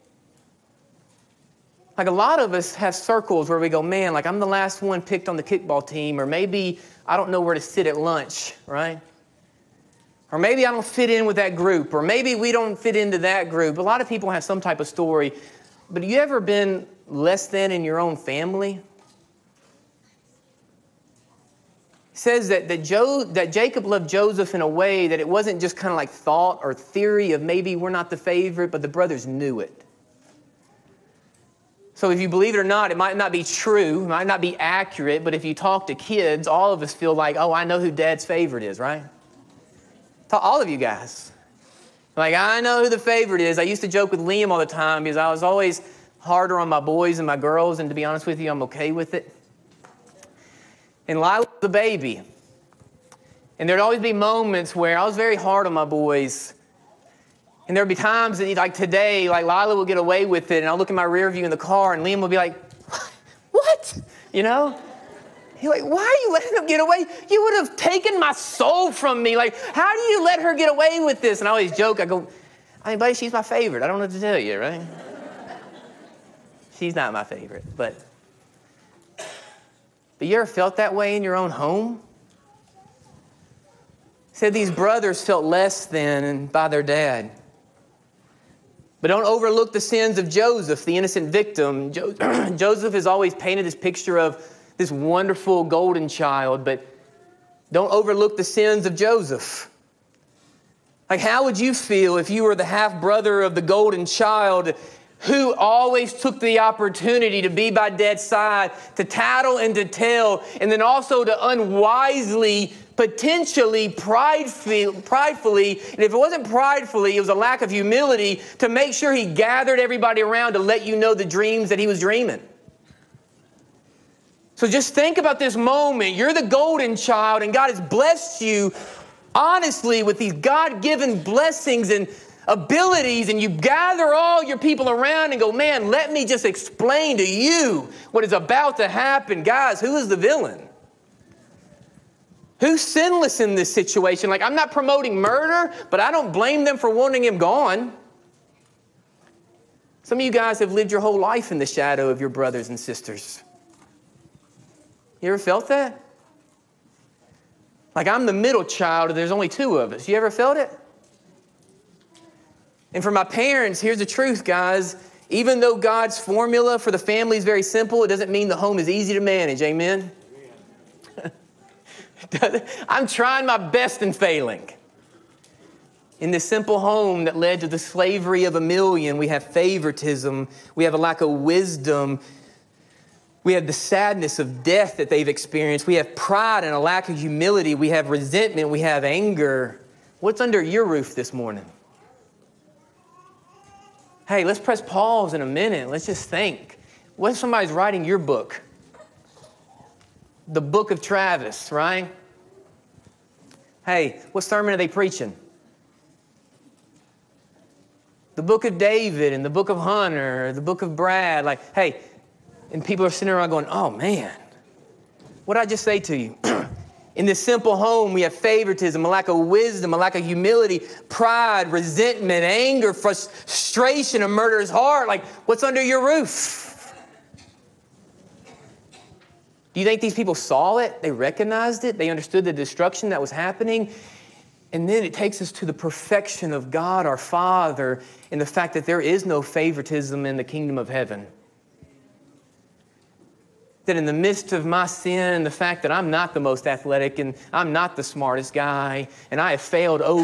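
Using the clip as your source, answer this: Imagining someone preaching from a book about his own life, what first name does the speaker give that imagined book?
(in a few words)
Travis.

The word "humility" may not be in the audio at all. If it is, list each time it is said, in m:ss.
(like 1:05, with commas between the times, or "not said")
1:57, 3:07, 3:40.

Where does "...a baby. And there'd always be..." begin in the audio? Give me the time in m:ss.
0:51.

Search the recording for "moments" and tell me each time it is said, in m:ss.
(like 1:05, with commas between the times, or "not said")
0:54, 2:05.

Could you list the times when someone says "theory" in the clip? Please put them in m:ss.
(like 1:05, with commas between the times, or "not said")
0:26.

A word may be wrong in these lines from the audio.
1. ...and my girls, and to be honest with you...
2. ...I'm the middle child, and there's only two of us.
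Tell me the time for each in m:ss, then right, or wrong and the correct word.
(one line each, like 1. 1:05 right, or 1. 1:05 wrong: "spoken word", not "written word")
1. 0:47 right
2. 2:38 right.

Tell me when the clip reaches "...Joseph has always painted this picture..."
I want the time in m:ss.
1:32.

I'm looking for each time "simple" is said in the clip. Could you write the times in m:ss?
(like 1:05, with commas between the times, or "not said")
2:47, 2:56, 3:37.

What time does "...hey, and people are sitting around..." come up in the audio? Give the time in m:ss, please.
3:31.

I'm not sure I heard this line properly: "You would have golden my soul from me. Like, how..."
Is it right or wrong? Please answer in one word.
wrong.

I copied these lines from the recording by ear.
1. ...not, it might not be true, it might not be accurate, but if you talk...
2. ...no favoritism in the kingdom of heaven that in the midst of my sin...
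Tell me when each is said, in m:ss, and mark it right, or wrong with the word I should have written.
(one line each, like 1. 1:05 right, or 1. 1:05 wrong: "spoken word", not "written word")
1. 0:32 right
2. 3:59 right.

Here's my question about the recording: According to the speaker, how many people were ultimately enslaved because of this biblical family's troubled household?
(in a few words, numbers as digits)
a million.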